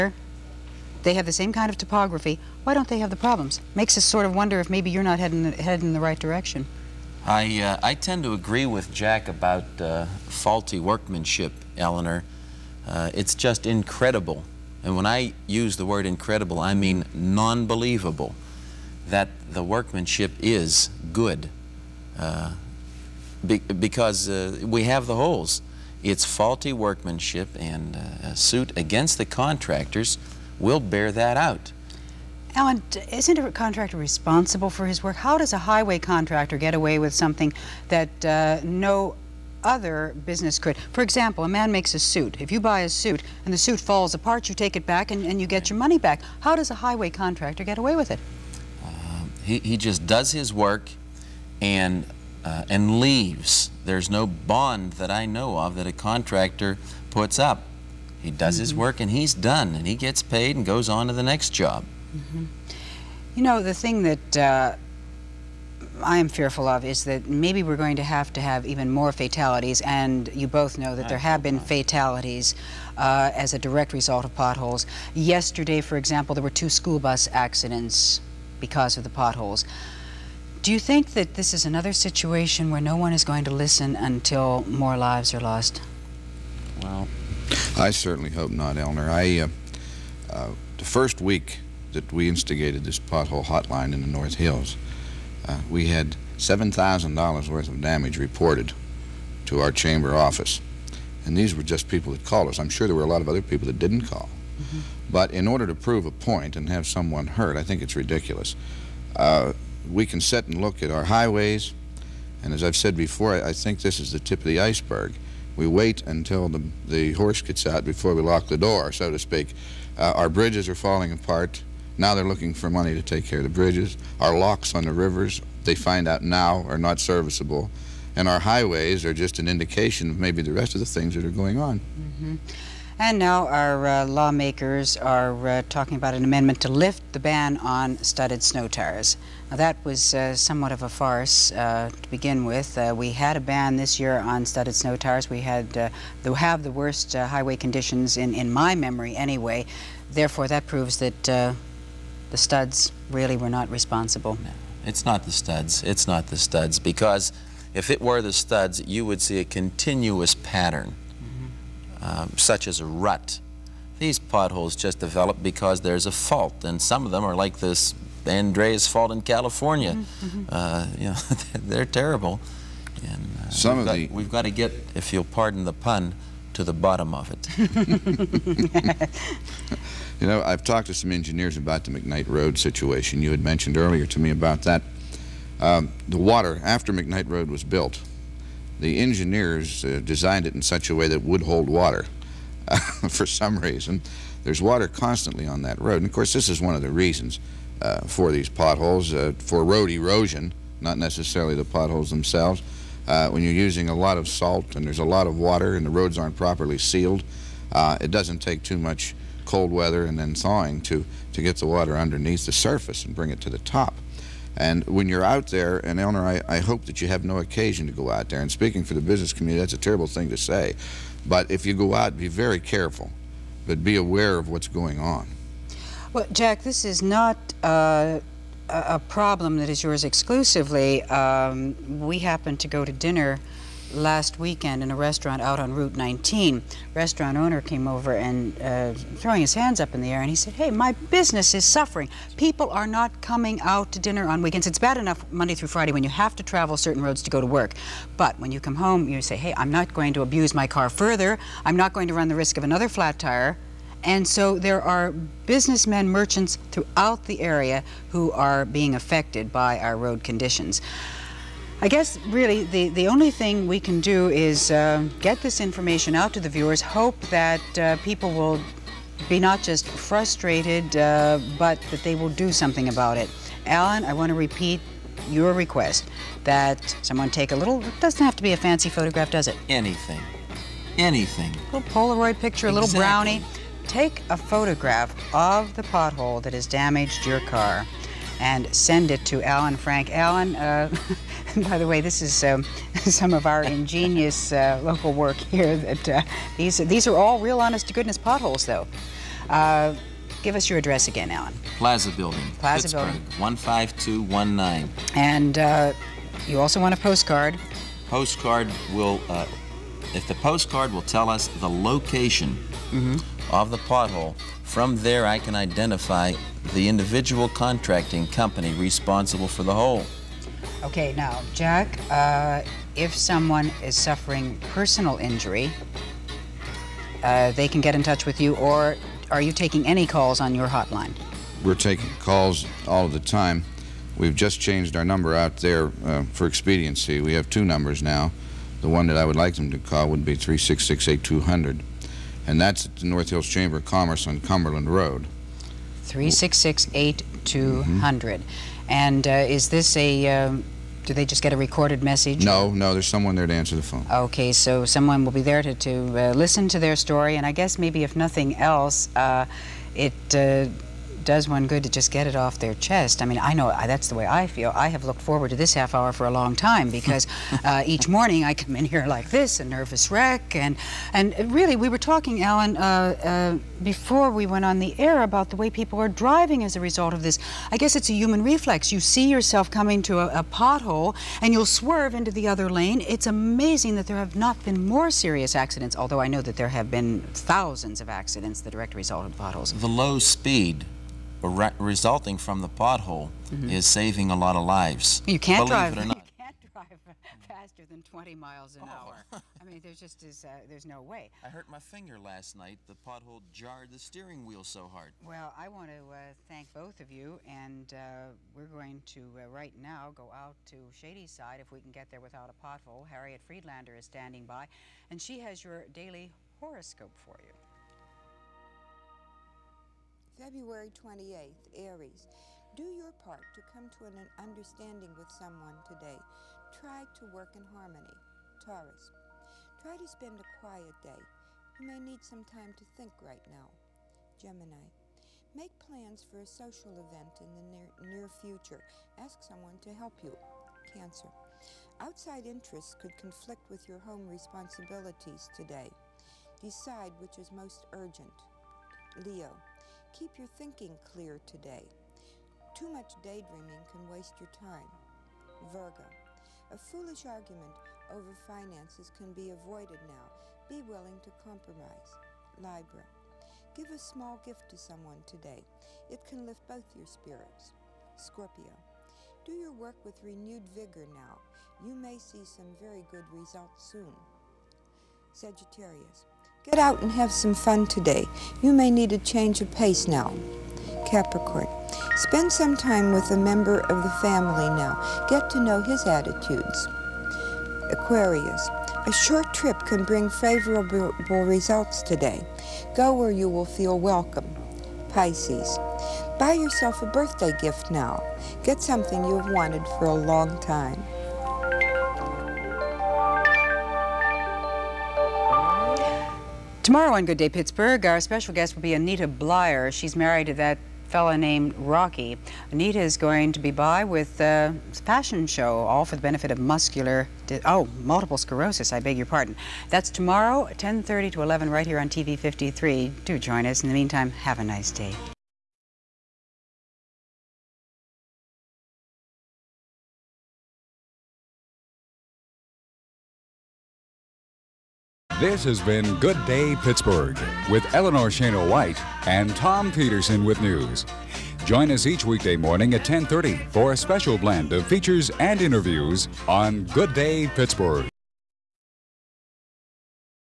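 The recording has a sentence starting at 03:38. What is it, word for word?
And speaking for the business community, that's a terrible thing to say.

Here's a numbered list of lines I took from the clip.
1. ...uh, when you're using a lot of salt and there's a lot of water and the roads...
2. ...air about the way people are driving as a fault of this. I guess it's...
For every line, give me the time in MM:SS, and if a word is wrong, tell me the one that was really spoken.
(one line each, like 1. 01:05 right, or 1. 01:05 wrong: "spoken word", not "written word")
1. 03:23 right
2. 06:14 wrong: "result", not "fault".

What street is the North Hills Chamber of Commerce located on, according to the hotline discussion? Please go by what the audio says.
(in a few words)
Cumberland Road.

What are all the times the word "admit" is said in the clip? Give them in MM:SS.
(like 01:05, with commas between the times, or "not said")
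not said.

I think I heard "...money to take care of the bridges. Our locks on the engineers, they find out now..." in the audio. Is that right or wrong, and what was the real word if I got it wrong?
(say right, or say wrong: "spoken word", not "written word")
wrong: "rivers", not "engineers".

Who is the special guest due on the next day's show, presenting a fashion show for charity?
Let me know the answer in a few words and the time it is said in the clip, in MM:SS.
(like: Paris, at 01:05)
Anita Bleier, at 08:28.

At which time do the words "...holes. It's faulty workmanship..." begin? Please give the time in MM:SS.
00:25.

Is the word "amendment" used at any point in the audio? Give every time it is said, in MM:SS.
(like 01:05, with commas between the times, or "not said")
02:16.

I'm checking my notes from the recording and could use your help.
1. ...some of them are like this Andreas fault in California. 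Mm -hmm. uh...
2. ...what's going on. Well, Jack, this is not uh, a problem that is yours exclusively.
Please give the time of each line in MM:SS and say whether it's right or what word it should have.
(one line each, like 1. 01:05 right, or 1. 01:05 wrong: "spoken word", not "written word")
1. 02:46 right
2. 03:44 right.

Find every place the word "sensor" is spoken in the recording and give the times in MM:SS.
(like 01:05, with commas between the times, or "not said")
not said.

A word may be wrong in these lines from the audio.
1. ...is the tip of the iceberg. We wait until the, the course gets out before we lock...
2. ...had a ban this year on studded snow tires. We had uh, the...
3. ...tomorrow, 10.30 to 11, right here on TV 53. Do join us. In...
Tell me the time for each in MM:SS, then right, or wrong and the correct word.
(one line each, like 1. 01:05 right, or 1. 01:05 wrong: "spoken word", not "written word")
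1. 01:54 wrong: "horse", not "course"
2. 02:23 right
3. 08:40 right.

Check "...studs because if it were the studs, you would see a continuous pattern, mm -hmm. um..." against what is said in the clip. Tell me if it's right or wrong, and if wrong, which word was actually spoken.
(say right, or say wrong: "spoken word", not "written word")
right.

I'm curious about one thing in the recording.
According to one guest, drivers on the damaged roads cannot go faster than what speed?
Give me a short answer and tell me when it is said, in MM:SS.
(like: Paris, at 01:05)
20 miles an hour, at 06:38.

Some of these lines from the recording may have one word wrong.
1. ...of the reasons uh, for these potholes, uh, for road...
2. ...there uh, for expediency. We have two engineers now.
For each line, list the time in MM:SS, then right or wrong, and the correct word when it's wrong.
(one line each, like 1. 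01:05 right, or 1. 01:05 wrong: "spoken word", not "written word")
1. 03:16 right
2. 05:35 wrong: "numbers", not "engineers".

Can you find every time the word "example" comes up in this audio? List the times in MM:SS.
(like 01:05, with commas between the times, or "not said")
00:41, 01:15.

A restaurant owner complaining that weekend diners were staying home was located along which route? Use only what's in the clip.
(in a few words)
Route 19.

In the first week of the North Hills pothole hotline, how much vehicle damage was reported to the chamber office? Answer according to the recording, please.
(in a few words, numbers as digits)
$7,000.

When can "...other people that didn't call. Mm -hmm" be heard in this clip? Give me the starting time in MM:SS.
01:43.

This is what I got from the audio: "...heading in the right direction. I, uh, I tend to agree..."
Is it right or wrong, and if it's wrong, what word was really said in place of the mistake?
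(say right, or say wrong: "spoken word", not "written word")
right.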